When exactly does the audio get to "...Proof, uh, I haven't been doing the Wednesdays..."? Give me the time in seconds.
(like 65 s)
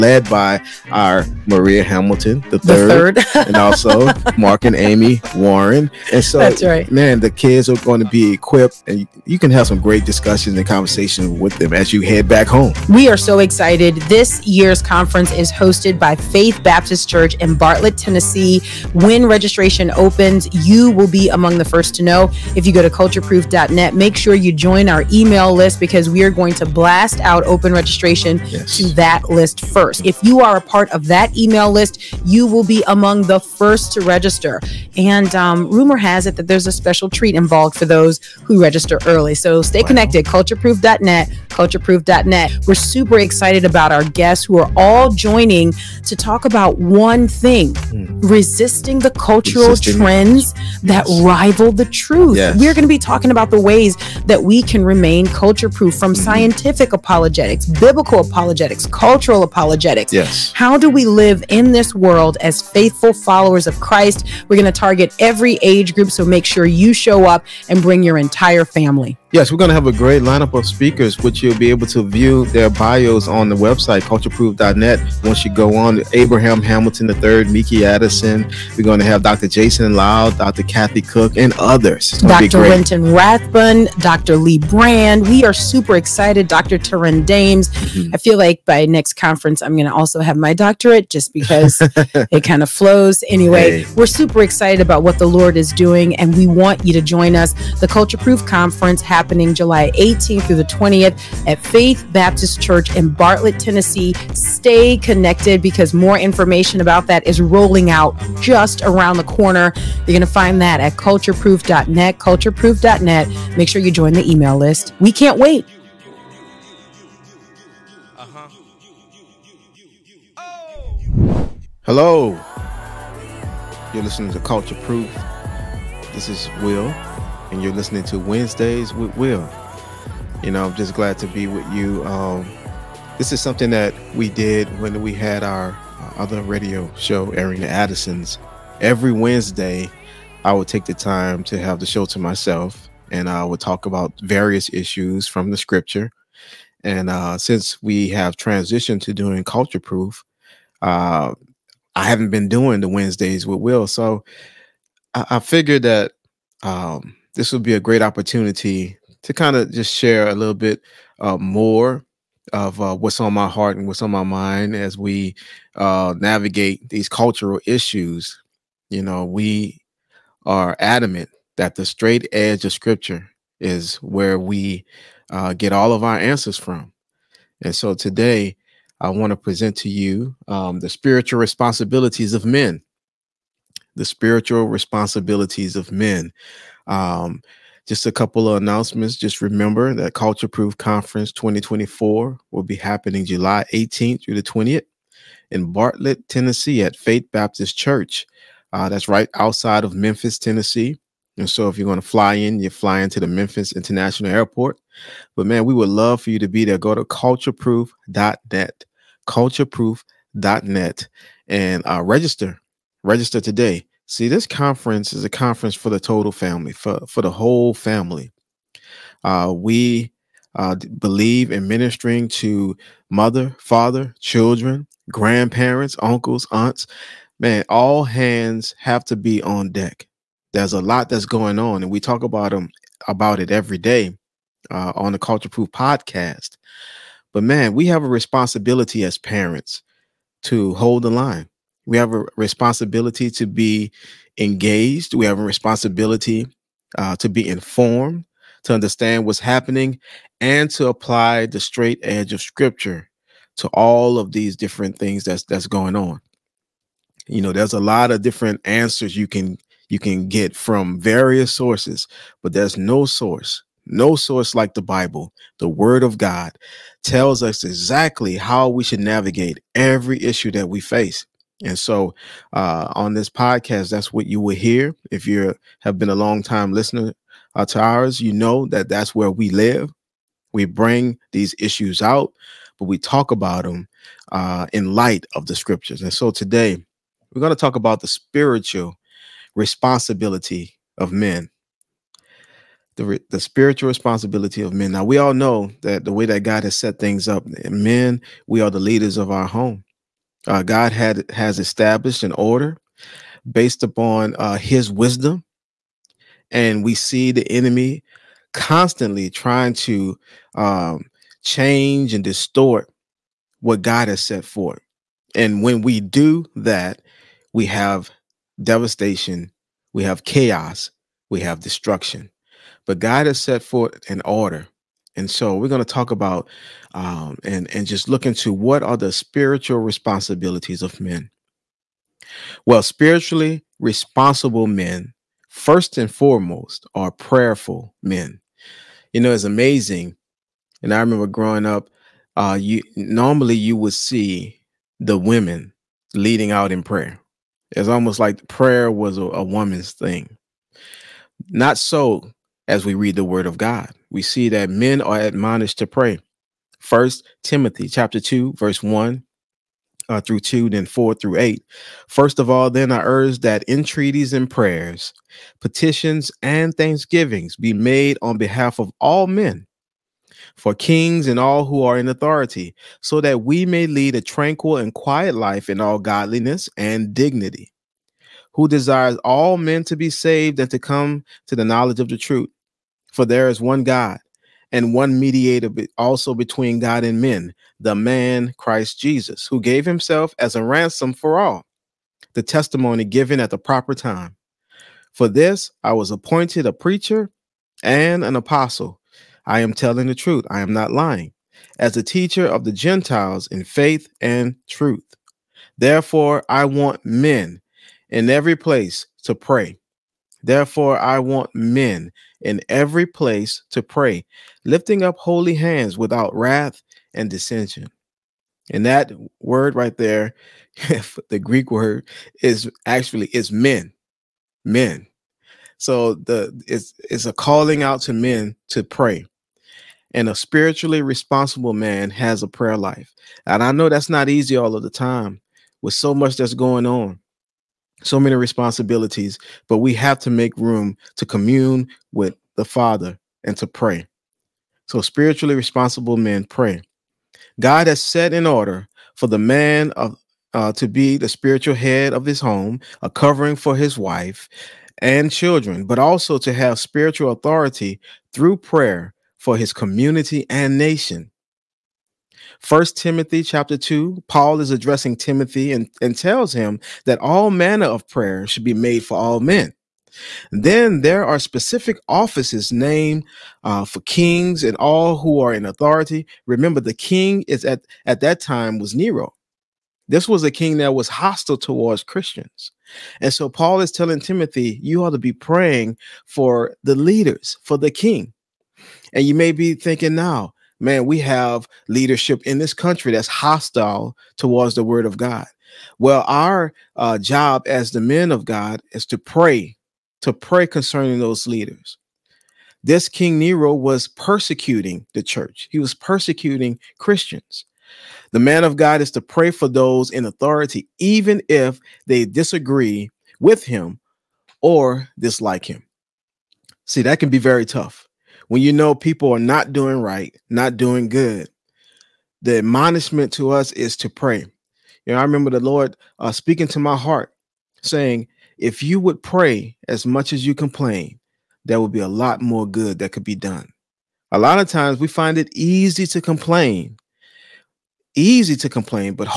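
149 s.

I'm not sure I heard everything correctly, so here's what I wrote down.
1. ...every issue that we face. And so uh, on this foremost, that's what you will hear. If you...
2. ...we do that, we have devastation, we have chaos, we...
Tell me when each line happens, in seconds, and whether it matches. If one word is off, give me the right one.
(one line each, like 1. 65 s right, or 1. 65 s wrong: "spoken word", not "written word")
1. 269 s wrong: "podcast", not "foremost"
2. 315 s right.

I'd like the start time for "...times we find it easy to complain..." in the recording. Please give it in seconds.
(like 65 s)
534 s.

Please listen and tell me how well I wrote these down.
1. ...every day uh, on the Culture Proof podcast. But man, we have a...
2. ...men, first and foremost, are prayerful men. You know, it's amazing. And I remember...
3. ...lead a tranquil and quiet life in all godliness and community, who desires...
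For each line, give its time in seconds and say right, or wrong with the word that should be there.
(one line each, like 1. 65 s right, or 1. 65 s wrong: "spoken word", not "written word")
1. 233 s right
2. 334 s right
3. 373 s wrong: "dignity", not "community".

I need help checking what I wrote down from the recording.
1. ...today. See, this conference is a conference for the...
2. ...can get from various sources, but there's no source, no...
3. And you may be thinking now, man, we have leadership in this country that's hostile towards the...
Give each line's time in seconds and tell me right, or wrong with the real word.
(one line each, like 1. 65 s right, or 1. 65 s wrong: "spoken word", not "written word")
1. 213 s right
2. 259 s right
3. 489 s right.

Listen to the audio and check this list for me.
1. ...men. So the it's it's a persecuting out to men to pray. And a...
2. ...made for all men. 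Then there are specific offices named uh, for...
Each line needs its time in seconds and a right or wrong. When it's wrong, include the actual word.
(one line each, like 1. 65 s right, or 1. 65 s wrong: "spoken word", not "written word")
1. 424 s wrong: "calling", not "persecuting"
2. 468 s right.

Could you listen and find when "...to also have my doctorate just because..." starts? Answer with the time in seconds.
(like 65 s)
89 s.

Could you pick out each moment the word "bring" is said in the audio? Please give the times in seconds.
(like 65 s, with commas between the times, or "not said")
67 s, 280 s.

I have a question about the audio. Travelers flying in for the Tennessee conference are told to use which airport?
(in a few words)
Memphis International Airport.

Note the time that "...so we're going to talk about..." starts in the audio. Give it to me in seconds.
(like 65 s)
325 s.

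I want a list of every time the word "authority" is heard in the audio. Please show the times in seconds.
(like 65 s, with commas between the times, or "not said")
372 s, 457 s, 475 s, 510 s.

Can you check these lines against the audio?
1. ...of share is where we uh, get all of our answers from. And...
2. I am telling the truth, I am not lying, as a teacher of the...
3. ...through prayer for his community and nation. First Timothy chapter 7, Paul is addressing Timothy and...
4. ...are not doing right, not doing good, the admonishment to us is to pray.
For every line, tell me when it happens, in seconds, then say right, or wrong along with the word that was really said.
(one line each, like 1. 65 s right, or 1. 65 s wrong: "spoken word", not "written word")
1. 172 s wrong: "scripture", not "share"
2. 399 s right
3. 458 s wrong: "2", not "7"
4. 519 s right.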